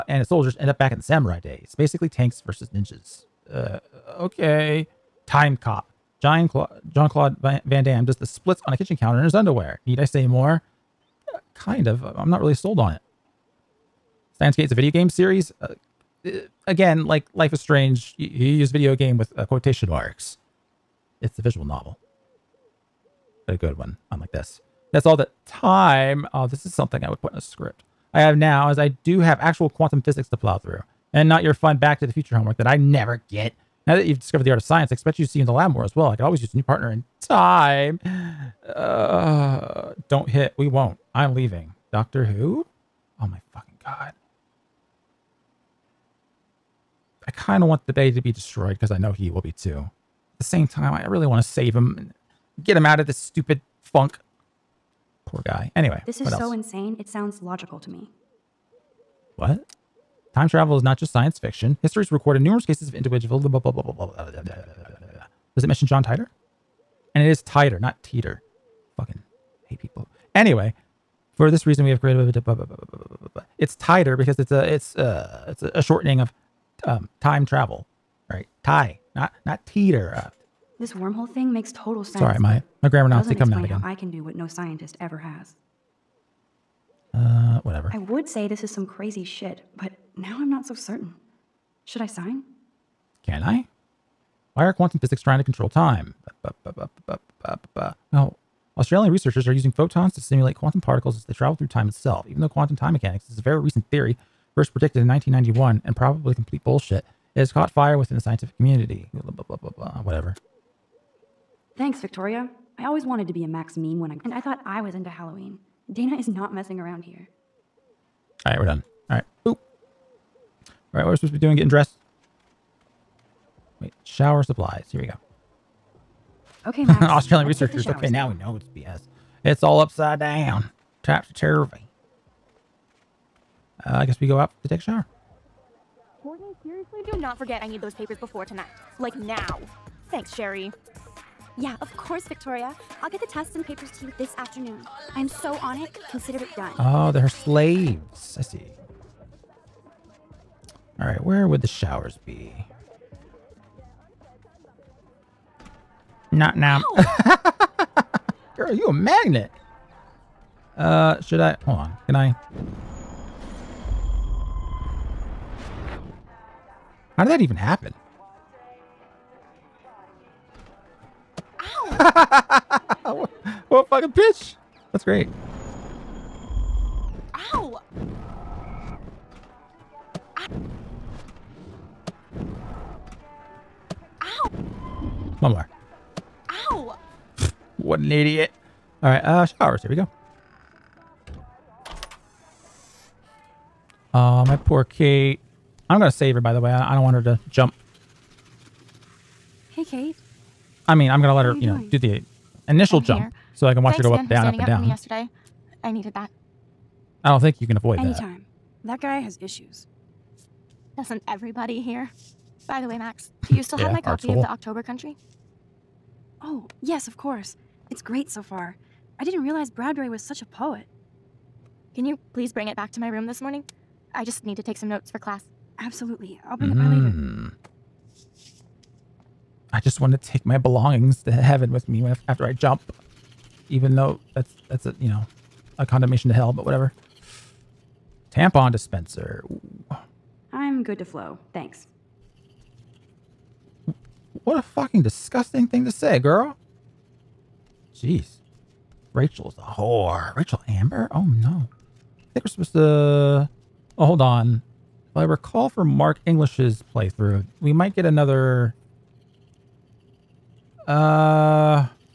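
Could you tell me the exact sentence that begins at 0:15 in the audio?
Uh, uh again, like Life is Strange, you, you use video game with uh, quotation marks.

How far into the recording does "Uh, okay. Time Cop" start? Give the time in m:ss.
0:03.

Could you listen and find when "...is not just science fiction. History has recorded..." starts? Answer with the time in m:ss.
1:00.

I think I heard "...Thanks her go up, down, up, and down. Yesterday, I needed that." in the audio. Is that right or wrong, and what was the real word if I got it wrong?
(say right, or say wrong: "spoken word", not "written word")
right.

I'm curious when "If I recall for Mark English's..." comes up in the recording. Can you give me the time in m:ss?
4:15.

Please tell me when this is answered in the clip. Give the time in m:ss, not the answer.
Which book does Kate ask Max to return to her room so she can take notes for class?
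3:34.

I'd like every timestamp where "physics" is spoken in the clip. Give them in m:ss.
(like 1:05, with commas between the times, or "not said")
0:30, 1:34.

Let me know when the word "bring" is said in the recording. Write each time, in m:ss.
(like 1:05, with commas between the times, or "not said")
3:42, 3:46.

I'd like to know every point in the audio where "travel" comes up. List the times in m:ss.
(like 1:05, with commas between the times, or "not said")
1:00, 1:17, 1:41.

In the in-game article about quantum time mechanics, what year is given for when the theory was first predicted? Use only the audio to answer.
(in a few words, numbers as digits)
1991.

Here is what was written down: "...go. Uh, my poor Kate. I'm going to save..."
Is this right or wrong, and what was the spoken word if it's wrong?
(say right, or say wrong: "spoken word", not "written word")
right.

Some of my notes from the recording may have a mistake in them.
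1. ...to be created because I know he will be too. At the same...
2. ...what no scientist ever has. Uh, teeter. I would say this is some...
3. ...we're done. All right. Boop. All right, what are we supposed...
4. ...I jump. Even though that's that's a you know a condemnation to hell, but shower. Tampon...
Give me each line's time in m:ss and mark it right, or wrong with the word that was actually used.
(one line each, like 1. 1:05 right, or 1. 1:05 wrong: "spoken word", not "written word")
1. 0:48 wrong: "destroyed", not "created"
2. 1:24 wrong: "whatever", not "teeter"
3. 1:58 right
4. 3:52 wrong: "whatever", not "shower".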